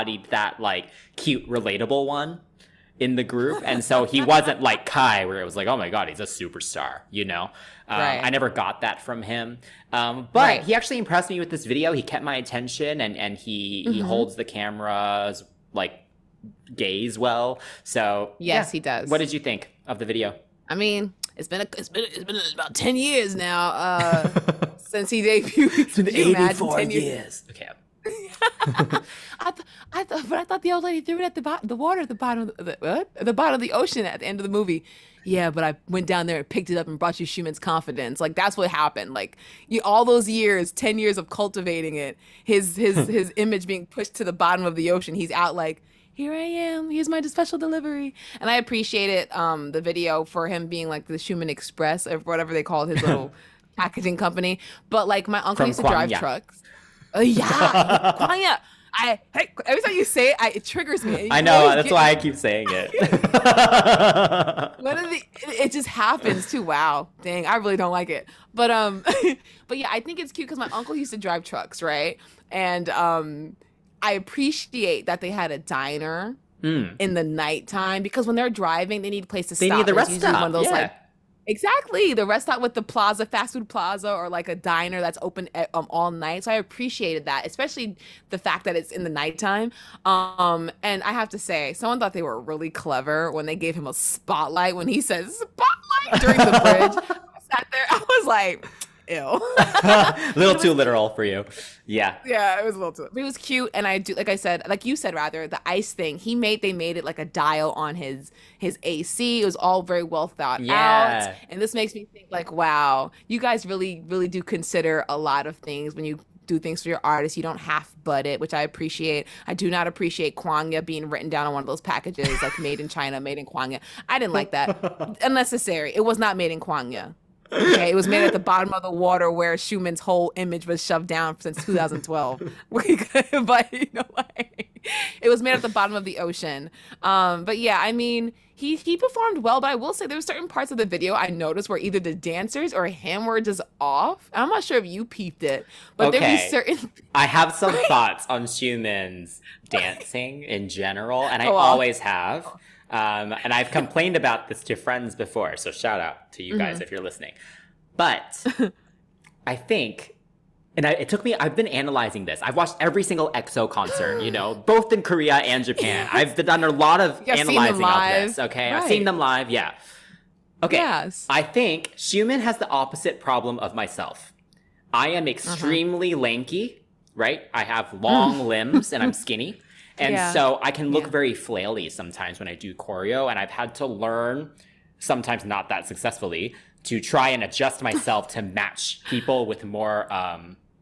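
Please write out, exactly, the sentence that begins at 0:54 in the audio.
But like my uncle From used to drive trucks.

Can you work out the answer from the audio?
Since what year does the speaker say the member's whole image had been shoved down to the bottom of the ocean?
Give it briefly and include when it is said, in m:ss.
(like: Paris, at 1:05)
2012, at 2:11.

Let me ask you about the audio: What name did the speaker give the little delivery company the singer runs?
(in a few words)
Xiumin Express.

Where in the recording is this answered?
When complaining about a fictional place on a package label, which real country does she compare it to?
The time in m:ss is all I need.
2:02.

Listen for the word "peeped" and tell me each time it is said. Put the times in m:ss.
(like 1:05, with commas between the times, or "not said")
2:25.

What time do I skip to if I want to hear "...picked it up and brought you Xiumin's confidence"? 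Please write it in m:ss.
0:36.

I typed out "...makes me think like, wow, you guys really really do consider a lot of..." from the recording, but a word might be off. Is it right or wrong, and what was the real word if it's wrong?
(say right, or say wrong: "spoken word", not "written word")
right.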